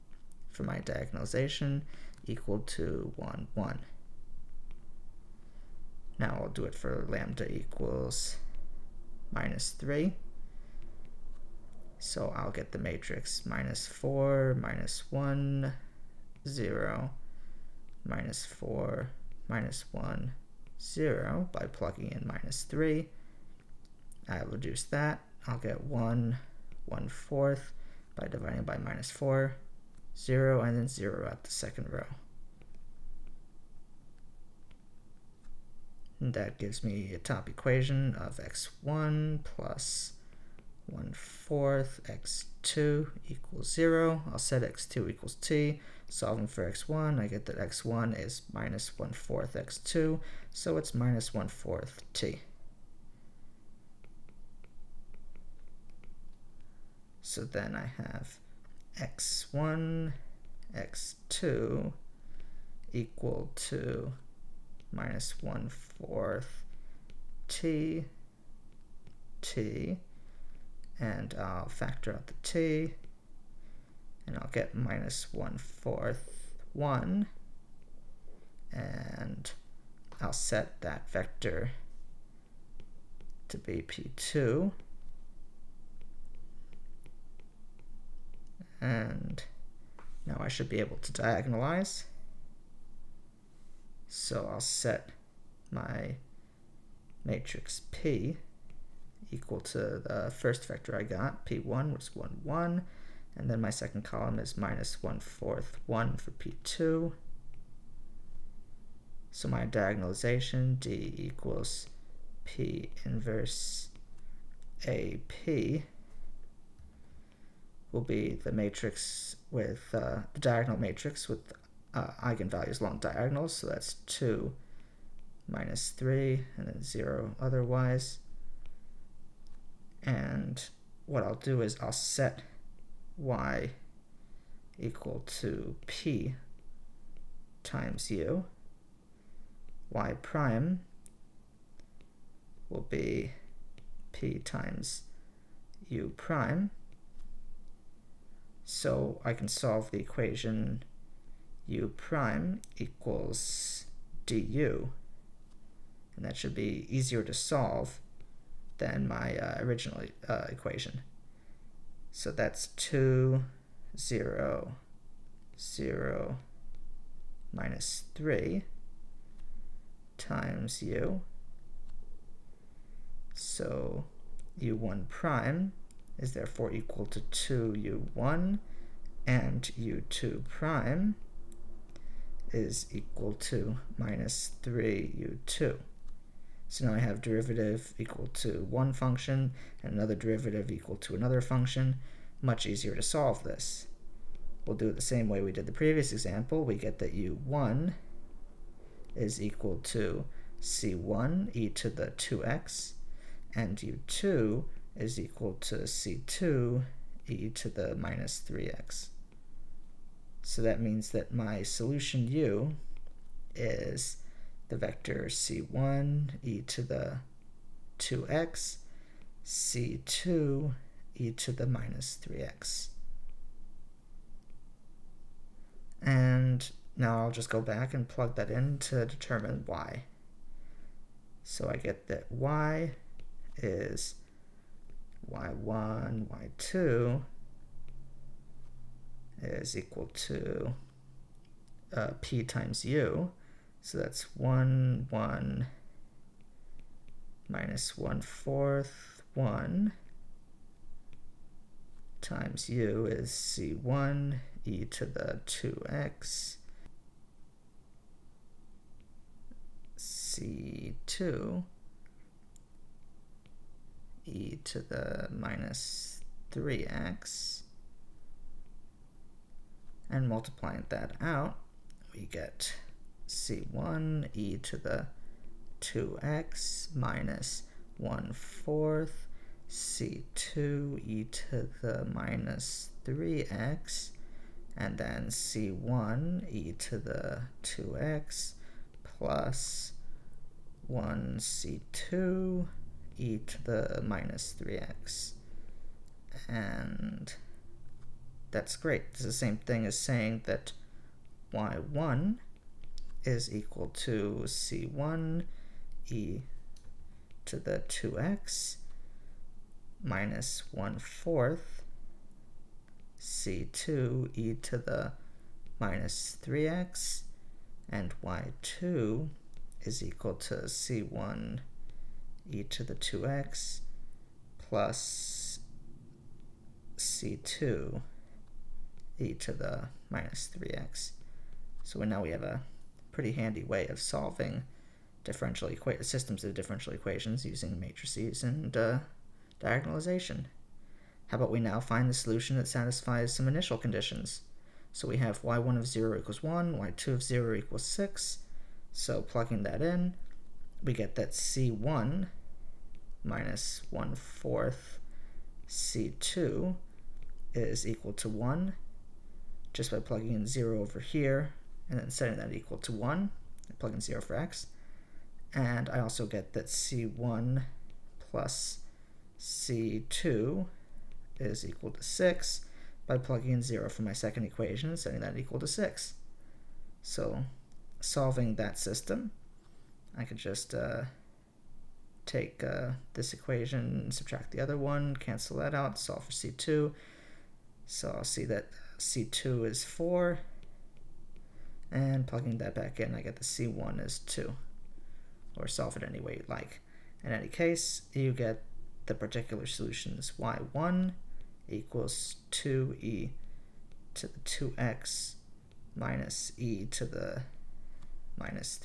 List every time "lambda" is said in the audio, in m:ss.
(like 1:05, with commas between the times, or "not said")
0:07.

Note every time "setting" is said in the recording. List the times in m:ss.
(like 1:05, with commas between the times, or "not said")
6:02, 6:14.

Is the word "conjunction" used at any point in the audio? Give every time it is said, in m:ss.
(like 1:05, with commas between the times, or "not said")
not said.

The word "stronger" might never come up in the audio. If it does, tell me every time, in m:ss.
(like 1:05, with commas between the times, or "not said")
not said.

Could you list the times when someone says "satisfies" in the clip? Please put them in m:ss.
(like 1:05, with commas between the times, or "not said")
5:42.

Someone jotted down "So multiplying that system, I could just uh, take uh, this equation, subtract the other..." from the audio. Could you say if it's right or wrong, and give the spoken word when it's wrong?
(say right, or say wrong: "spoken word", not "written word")
wrong: "solving", not "multiplying".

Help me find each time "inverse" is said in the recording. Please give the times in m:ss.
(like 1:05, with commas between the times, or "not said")
1:53.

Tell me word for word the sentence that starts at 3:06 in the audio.
So now I have derivative equal to one function and another derivative equal to another function.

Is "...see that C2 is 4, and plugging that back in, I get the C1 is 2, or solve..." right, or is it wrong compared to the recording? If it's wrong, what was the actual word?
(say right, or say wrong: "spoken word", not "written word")
right.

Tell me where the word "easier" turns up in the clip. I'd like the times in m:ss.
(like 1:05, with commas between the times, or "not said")
2:36, 3:12.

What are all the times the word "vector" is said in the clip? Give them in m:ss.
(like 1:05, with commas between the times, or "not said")
1:21, 1:40, 3:34.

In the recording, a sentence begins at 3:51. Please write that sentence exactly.
So I get that y is y1, y2 is equal to uh, p times u.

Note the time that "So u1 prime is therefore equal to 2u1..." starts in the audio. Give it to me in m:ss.
2:53.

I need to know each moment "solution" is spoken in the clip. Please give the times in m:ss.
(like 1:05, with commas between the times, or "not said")
3:31, 5:42, 6:39.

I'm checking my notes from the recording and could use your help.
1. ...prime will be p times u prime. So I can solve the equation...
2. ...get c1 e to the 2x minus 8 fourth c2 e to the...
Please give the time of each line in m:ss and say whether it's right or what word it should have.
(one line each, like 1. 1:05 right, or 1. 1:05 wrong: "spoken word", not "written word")
1. 2:20 right
2. 4:32 wrong: "1", not "8".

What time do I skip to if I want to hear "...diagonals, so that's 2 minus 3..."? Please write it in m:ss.
2:02.